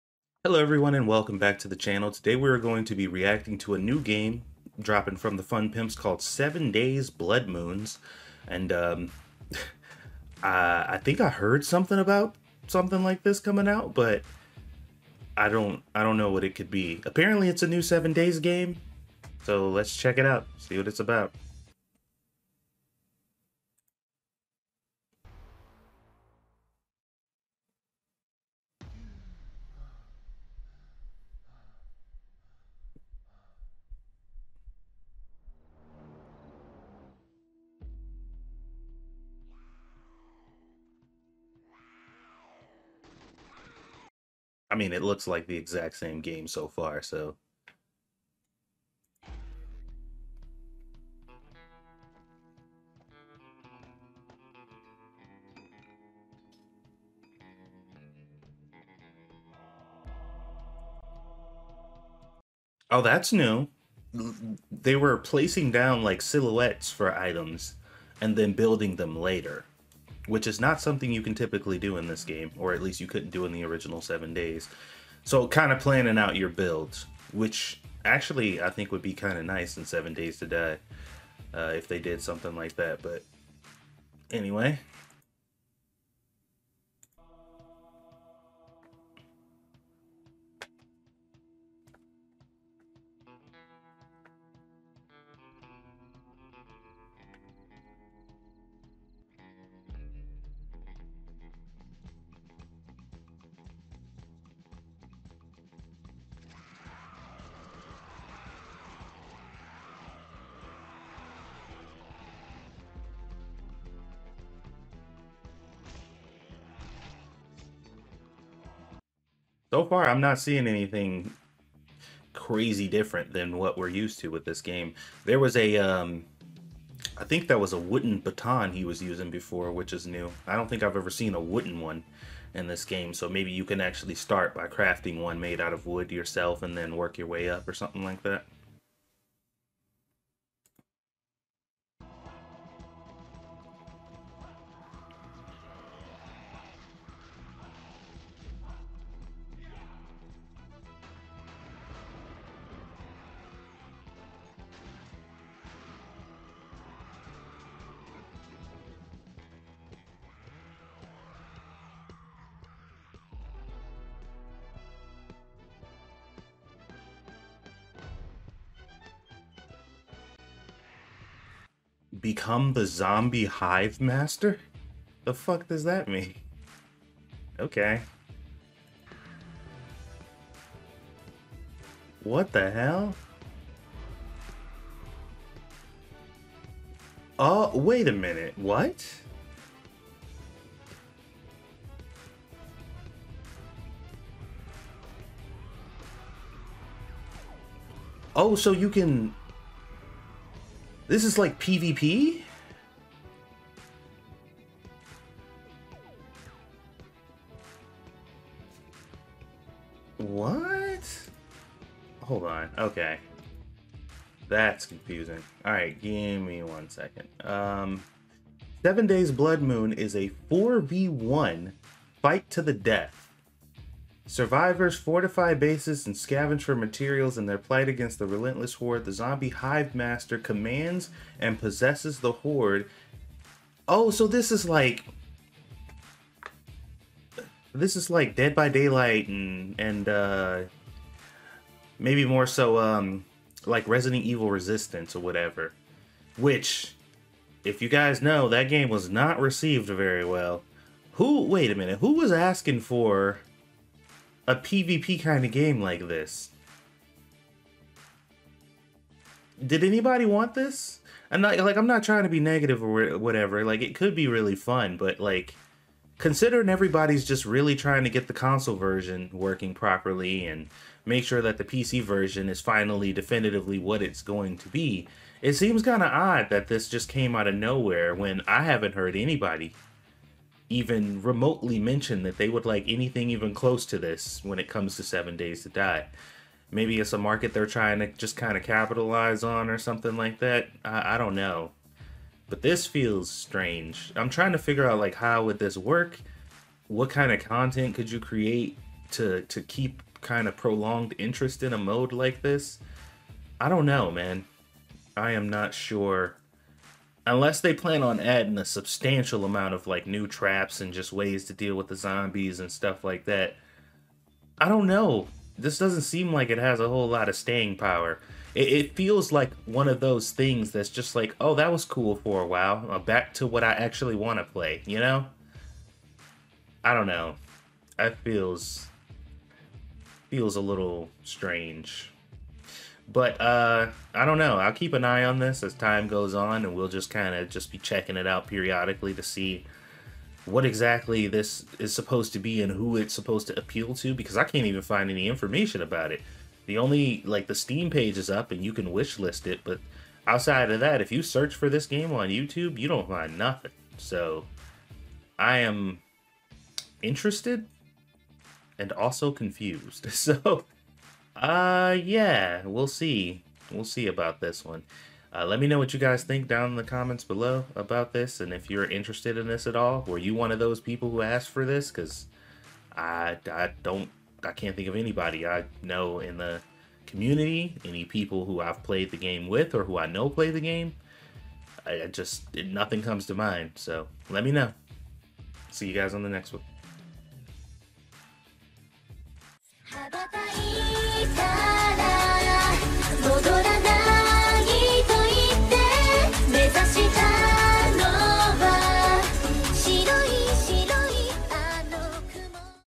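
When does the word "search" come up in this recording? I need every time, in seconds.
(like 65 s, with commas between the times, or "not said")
351 s.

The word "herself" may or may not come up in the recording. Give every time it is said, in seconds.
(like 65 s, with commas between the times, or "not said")
not said.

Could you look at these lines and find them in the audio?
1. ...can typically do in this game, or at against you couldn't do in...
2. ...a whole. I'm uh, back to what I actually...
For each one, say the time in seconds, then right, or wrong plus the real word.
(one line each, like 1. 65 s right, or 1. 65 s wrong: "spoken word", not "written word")
1. 71 s wrong: "least", not "against"
2. 322 s wrong: "while", not "whole".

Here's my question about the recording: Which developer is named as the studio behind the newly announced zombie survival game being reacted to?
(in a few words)
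The Fun Pimps.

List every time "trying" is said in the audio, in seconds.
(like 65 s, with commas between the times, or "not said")
262 s, 267 s, 287 s, 294 s.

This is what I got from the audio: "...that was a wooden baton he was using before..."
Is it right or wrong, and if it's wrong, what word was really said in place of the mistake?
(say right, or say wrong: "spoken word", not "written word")
right.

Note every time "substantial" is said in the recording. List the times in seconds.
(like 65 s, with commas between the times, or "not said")
308 s.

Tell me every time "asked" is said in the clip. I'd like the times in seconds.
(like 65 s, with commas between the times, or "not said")
371 s.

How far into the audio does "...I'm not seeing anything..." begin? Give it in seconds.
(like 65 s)
120 s.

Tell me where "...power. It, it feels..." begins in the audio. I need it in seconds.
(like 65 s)
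317 s.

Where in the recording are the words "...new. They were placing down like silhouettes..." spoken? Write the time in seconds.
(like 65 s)
63 s.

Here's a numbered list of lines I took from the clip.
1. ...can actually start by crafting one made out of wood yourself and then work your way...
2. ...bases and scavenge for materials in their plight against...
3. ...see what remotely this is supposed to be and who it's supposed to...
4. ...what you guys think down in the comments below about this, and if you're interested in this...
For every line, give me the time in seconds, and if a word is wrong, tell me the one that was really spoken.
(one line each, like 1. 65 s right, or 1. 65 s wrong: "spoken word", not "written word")
1. 133 s right
2. 225 s right
3. 339 s wrong: "exactly", not "remotely"
4. 365 s right.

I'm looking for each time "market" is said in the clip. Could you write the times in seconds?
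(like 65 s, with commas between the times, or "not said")
287 s.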